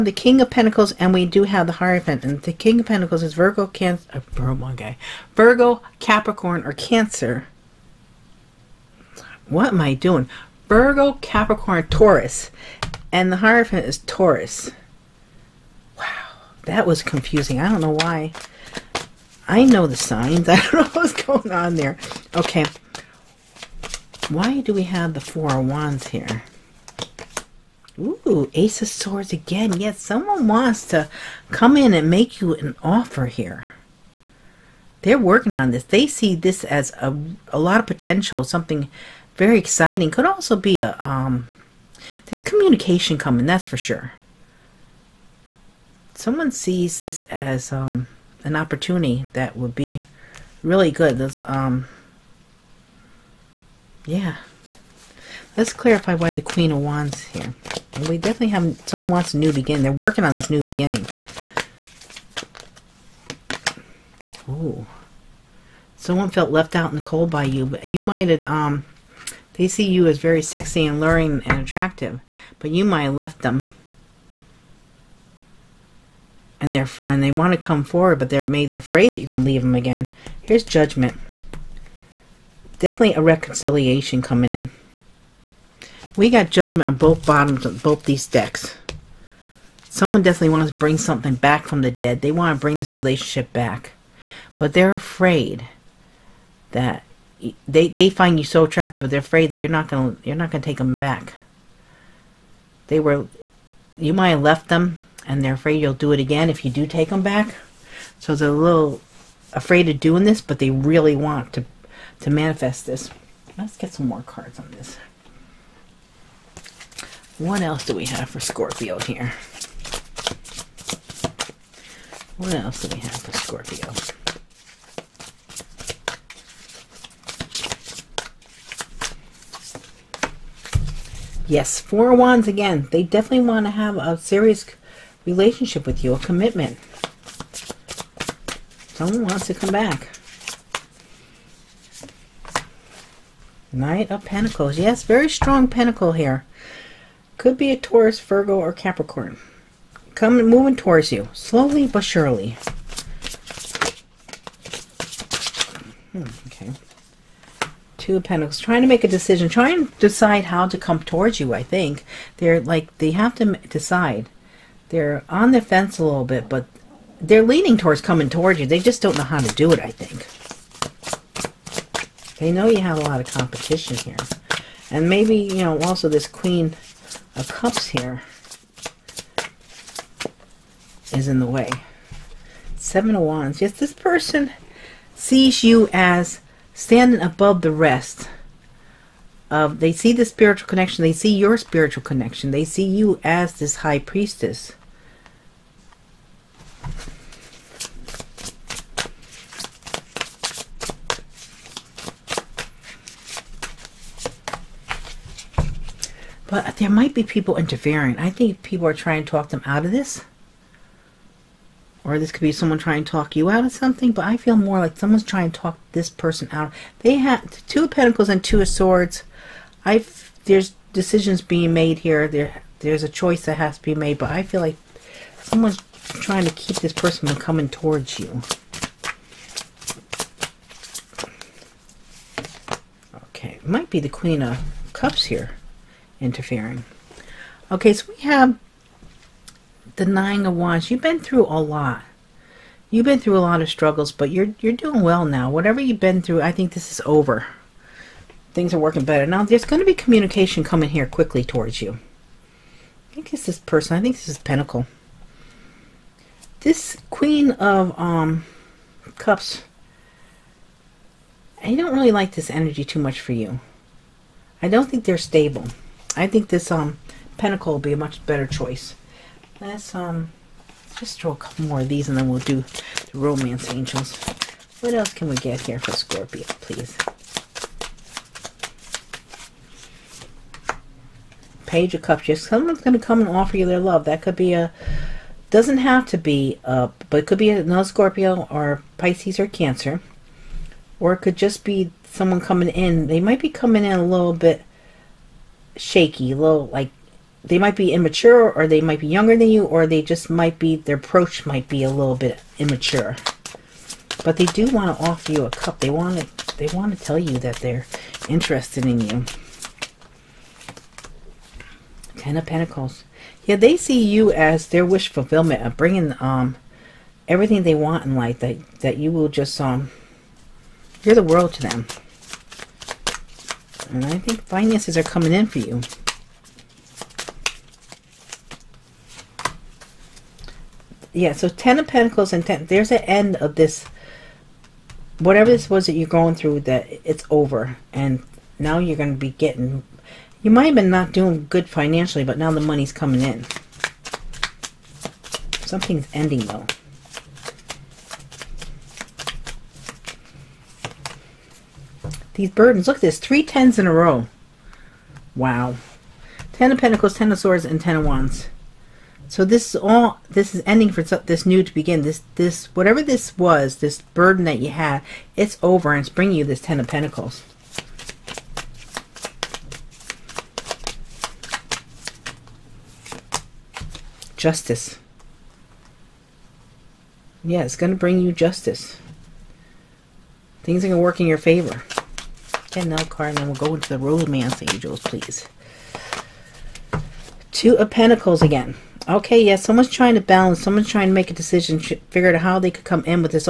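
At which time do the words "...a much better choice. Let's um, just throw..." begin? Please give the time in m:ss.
4:27.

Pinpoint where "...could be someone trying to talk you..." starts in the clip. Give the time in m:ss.
3:32.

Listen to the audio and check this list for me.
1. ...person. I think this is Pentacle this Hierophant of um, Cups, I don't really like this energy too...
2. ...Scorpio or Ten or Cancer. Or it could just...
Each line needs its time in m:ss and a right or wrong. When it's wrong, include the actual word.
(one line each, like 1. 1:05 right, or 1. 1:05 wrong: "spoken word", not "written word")
1. 4:13 wrong: "Queen", not "Hierophant"
2. 4:47 wrong: "Pisces", not "Ten".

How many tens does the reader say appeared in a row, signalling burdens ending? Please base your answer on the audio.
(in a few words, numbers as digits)
3.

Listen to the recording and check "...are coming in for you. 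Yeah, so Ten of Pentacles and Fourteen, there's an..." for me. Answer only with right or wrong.
wrong.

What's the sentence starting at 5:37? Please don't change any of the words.
And now you're going to be getting you might have been not doing good financially, but now the money's coming in.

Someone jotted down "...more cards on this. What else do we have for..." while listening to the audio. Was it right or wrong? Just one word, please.
right.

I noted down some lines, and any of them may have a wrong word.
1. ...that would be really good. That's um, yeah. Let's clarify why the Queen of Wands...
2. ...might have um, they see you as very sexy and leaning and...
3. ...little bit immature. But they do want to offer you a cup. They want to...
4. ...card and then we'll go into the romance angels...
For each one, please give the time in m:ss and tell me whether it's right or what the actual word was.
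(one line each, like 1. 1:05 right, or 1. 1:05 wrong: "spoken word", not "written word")
1. 0:49 right
2. 1:08 wrong: "luring", not "leaning"
3. 5:01 right
4. 6:23 right.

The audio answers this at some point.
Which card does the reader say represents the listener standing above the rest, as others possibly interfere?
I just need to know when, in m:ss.
3:02.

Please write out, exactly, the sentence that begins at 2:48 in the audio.
They just don't know how to do it, I think.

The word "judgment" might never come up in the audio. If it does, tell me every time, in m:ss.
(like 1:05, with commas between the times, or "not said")
1:20, 1:26.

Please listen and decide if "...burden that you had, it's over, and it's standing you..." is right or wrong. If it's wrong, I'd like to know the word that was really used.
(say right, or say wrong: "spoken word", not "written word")
wrong: "bringing", not "standing".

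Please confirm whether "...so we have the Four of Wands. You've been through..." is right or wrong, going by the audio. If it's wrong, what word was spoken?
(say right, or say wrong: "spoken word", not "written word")
wrong: "Nine", not "Four".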